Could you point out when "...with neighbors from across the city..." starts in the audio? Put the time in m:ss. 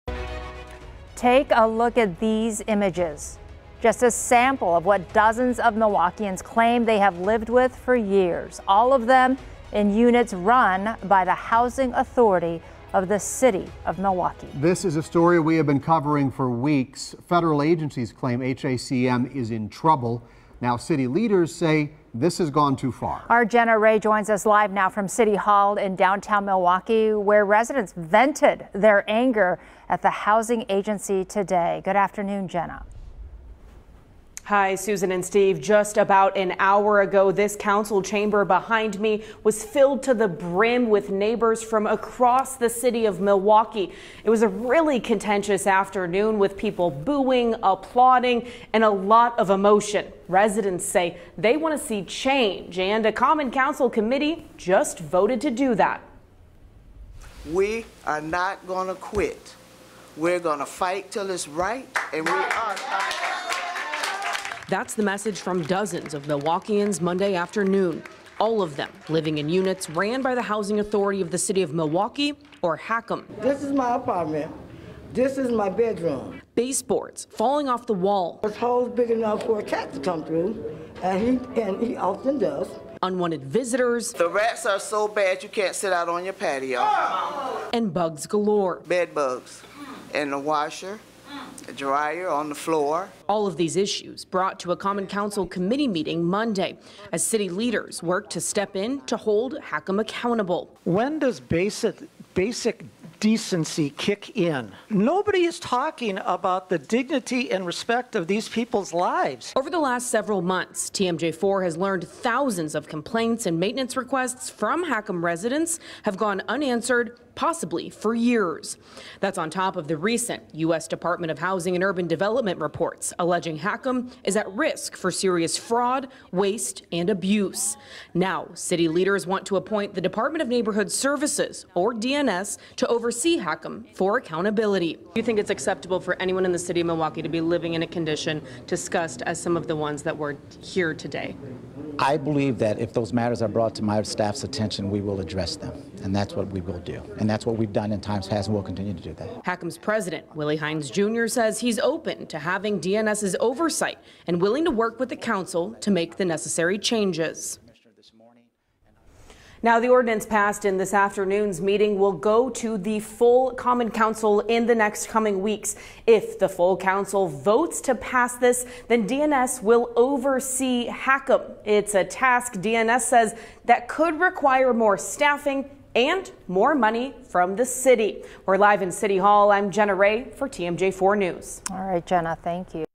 0:40.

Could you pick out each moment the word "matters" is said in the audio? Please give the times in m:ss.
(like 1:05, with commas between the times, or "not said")
2:23.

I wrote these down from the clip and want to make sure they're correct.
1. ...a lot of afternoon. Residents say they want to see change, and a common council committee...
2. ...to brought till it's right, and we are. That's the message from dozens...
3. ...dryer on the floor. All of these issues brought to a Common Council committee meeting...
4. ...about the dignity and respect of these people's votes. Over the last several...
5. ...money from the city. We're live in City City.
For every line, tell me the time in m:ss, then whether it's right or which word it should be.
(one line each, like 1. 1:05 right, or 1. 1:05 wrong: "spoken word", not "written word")
1. 0:48 wrong: "emotion", not "afternoon"
2. 1:00 wrong: "fight", not "brought"
3. 1:31 right
4. 1:46 wrong: "lives", not "votes"
5. 2:56 wrong: "Hall", not "City".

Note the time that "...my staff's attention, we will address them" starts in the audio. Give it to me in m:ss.
2:23.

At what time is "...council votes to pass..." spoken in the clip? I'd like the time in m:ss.
2:46.